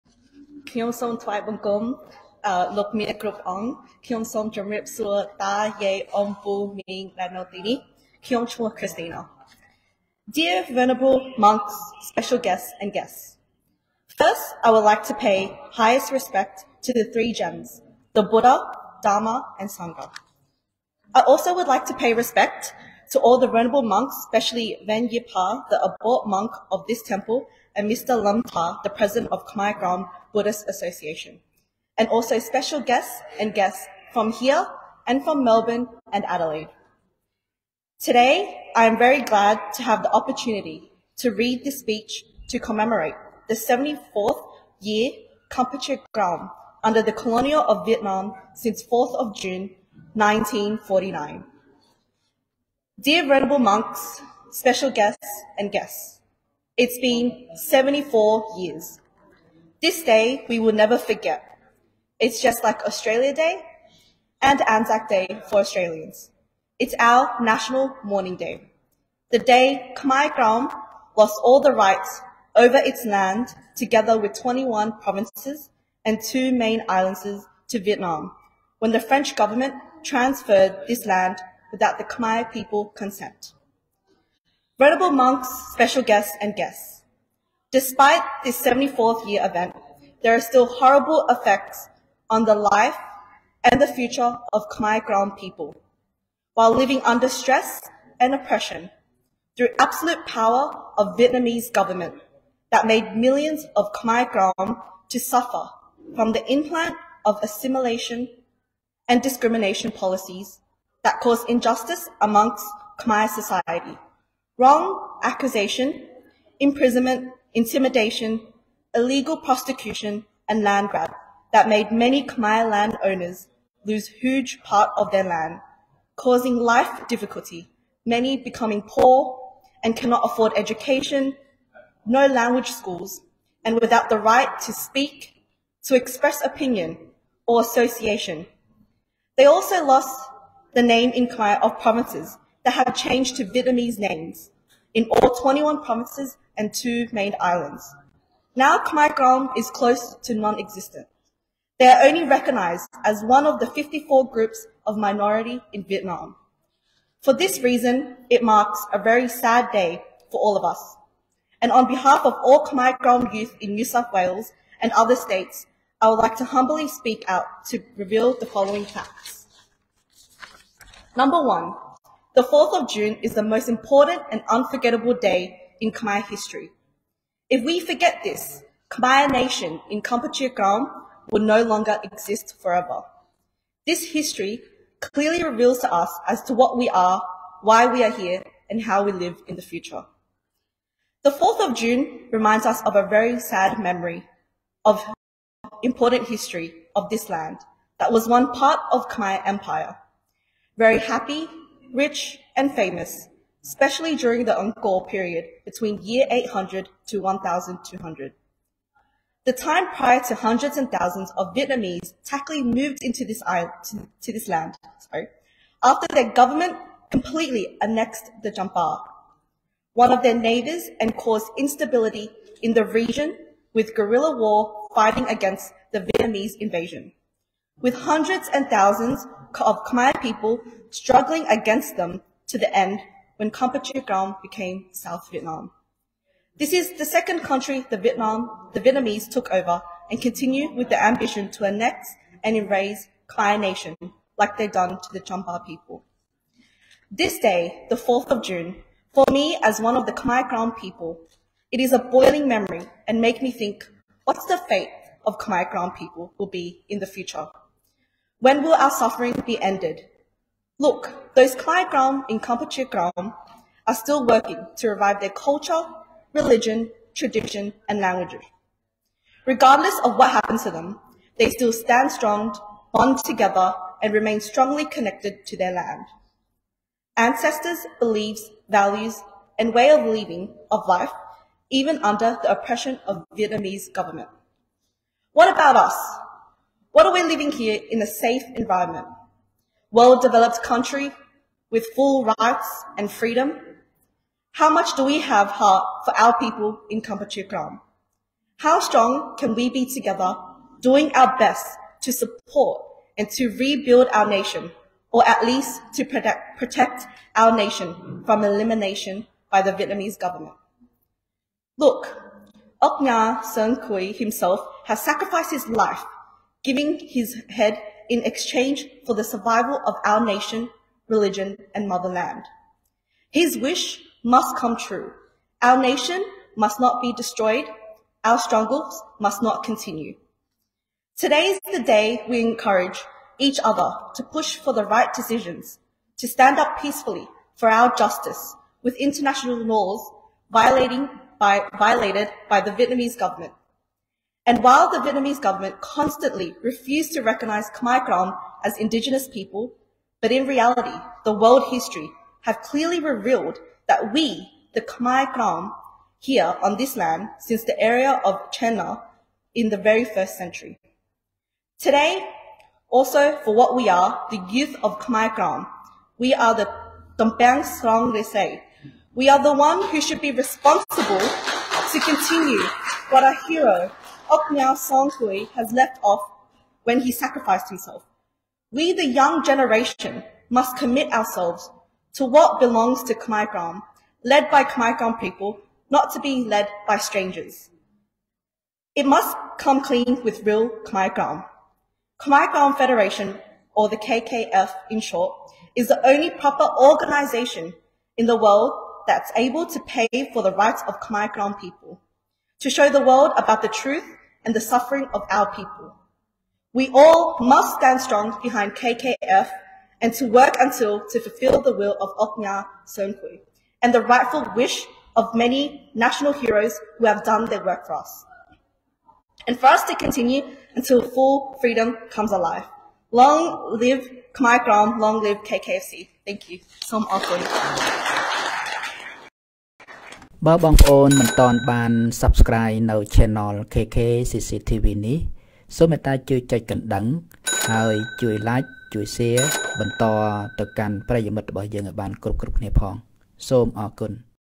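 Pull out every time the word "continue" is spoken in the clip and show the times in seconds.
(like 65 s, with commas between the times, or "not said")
240 s, 329 s, 371 s, 419 s.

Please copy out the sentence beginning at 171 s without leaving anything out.
Number one, the 4th of June is the most important and unforgettable day in Khmer history.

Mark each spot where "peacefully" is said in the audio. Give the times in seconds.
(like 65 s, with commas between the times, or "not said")
336 s.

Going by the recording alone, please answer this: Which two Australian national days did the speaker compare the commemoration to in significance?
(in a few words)
Australia Day and Anzac Day.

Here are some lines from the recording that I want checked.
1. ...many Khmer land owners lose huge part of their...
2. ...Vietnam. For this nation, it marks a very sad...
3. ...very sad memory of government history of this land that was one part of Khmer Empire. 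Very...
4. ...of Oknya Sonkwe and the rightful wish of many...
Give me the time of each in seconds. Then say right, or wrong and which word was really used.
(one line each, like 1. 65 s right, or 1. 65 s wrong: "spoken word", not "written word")
1. 122 s right
2. 155 s wrong: "reason", not "nation"
3. 193 s wrong: "important", not "government"
4. 412 s right.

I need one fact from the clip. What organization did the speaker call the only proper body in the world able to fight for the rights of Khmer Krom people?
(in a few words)
Khmer Krom Federation.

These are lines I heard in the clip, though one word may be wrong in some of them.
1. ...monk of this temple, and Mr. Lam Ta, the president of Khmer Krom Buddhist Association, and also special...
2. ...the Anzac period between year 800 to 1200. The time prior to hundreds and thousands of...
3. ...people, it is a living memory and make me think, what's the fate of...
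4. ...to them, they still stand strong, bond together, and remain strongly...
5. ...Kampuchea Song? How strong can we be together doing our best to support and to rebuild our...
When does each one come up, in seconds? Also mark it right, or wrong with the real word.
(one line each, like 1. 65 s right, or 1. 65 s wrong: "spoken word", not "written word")
1. 26 s right
2. 204 s wrong: "Angkor", not "Anzac"
3. 250 s wrong: "boiling", not "living"
4. 270 s right
5. 297 s wrong: "Krom", not "Song".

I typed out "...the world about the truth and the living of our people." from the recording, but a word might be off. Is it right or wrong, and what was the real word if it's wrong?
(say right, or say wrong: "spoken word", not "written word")
wrong: "suffering", not "living".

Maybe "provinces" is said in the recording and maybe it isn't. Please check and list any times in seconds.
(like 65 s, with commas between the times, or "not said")
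75 s, 141 s, 145 s.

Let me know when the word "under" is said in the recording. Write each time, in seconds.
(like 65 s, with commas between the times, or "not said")
46 s, 97 s, 281 s.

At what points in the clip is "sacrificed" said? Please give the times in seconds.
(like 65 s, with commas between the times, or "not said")
315 s, 377 s.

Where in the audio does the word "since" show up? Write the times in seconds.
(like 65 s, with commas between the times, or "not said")
48 s, 357 s.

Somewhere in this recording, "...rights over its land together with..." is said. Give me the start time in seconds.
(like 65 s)
71 s.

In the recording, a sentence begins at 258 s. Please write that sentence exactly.
When will our suffering be ended?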